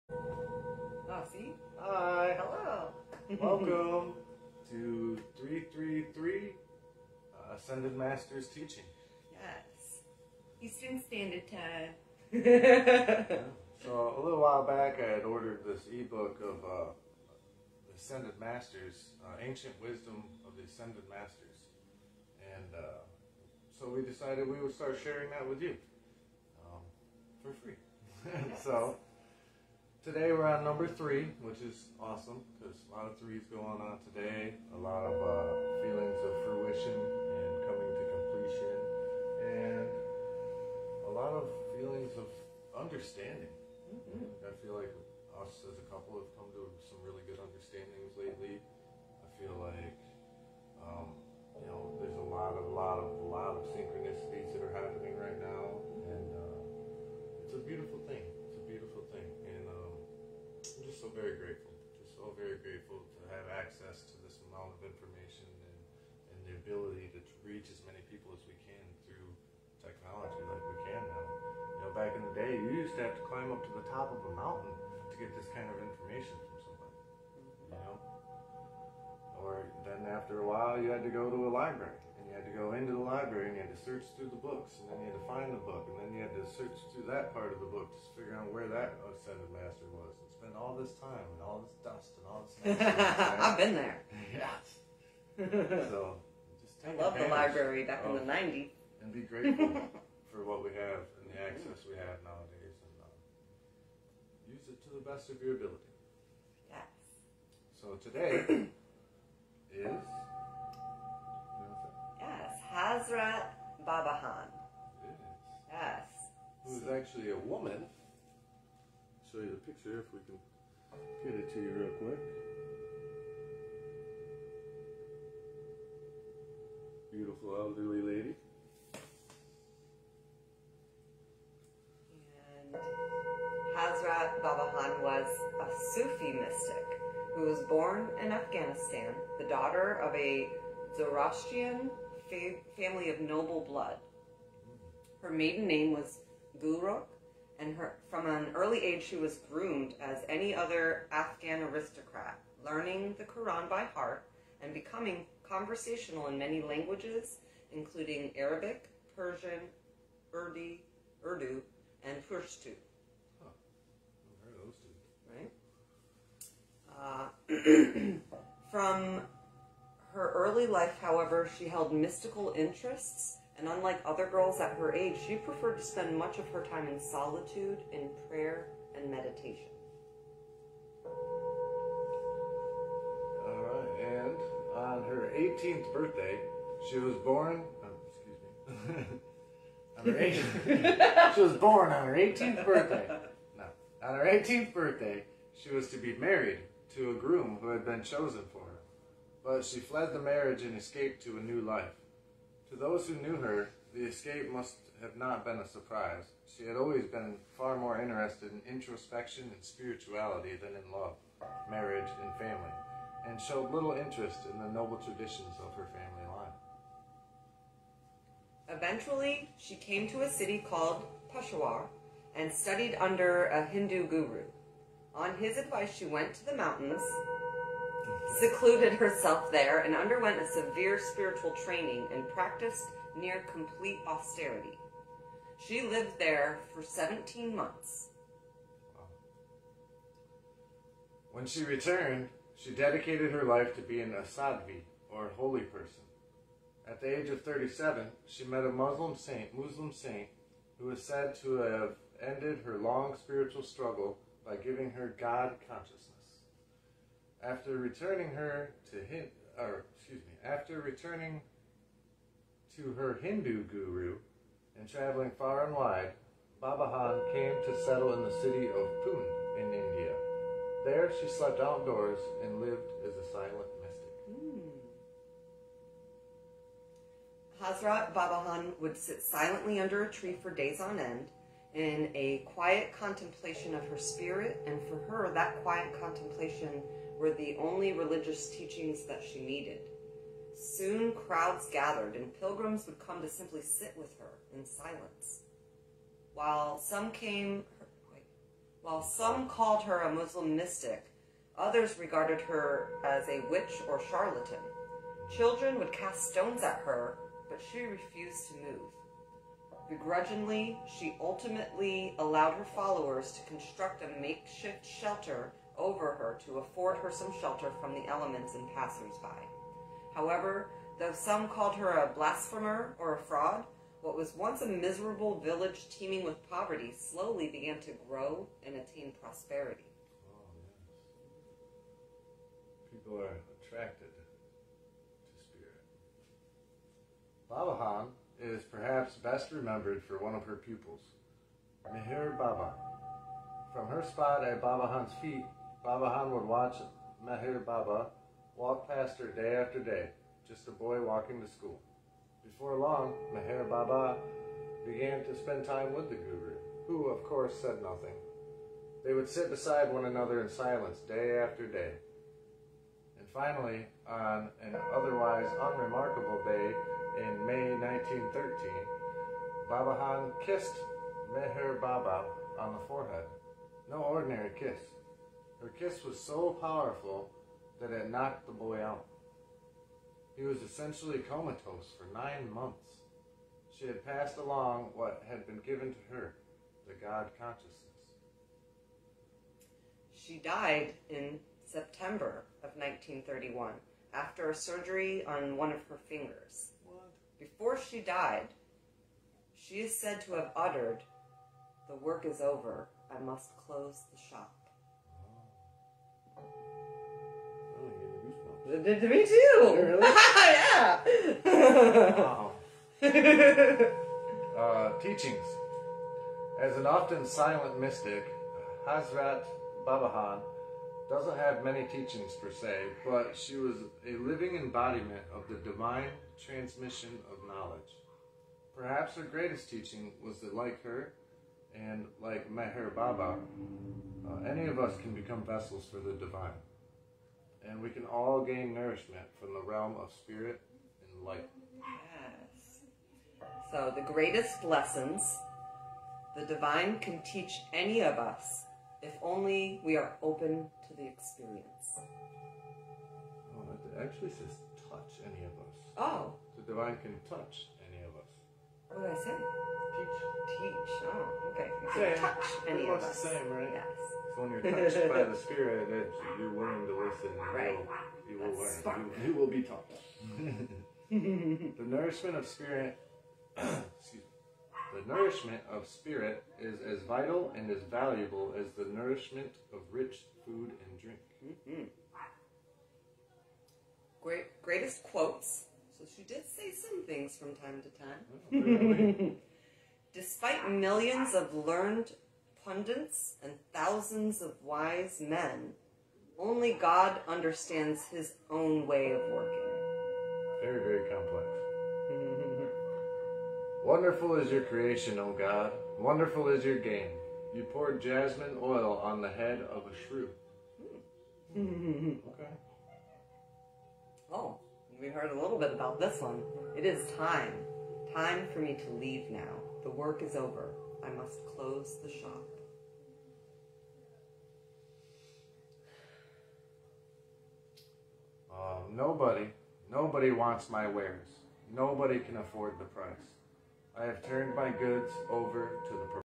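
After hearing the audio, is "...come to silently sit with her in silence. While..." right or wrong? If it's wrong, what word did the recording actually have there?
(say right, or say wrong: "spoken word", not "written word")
wrong: "simply", not "silently".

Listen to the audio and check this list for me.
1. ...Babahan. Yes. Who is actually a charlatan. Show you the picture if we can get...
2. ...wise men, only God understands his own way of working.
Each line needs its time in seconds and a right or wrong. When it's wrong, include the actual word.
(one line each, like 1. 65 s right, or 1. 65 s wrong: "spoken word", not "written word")
1. 113 s wrong: "woman", not "charlatan"
2. 494 s right.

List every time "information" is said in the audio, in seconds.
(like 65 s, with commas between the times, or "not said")
64 s, 75 s.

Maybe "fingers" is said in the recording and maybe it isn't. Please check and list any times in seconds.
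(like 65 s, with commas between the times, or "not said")
396 s.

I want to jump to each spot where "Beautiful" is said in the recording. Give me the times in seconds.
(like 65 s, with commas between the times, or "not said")
127 s.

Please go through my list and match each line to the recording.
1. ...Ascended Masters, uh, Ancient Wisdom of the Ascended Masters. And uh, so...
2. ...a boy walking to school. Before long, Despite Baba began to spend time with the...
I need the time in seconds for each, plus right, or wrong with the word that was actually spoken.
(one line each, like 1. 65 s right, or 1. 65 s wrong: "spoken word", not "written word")
1. 17 s right
2. 350 s wrong: "Meher", not "Despite".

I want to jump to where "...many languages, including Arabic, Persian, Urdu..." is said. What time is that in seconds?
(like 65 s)
156 s.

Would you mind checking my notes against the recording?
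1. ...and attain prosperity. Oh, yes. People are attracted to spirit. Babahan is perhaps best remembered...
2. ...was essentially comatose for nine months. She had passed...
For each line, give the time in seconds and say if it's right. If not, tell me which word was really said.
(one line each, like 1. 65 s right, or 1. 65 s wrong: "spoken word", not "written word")
1. 328 s right
2. 380 s right.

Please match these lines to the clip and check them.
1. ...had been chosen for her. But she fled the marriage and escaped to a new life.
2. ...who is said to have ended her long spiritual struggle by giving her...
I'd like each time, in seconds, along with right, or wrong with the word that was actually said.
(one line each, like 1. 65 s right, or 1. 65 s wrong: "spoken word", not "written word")
1. 197 s right
2. 250 s right.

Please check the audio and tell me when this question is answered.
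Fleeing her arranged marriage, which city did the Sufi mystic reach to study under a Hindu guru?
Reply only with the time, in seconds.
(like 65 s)
221 s.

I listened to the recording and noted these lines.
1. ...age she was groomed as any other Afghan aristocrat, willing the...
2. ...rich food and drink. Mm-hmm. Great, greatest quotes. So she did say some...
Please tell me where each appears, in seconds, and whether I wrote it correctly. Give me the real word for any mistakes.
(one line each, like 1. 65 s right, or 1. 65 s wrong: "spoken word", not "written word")
1. 148 s wrong: "learning", not "willing"
2. 479 s right.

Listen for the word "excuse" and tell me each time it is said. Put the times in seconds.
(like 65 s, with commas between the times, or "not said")
188 s, 259 s, 473 s.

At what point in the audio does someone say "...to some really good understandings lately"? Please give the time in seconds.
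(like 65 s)
46 s.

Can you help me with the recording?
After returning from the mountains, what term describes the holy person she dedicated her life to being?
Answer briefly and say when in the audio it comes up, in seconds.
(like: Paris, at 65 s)
sadhvi, at 244 s.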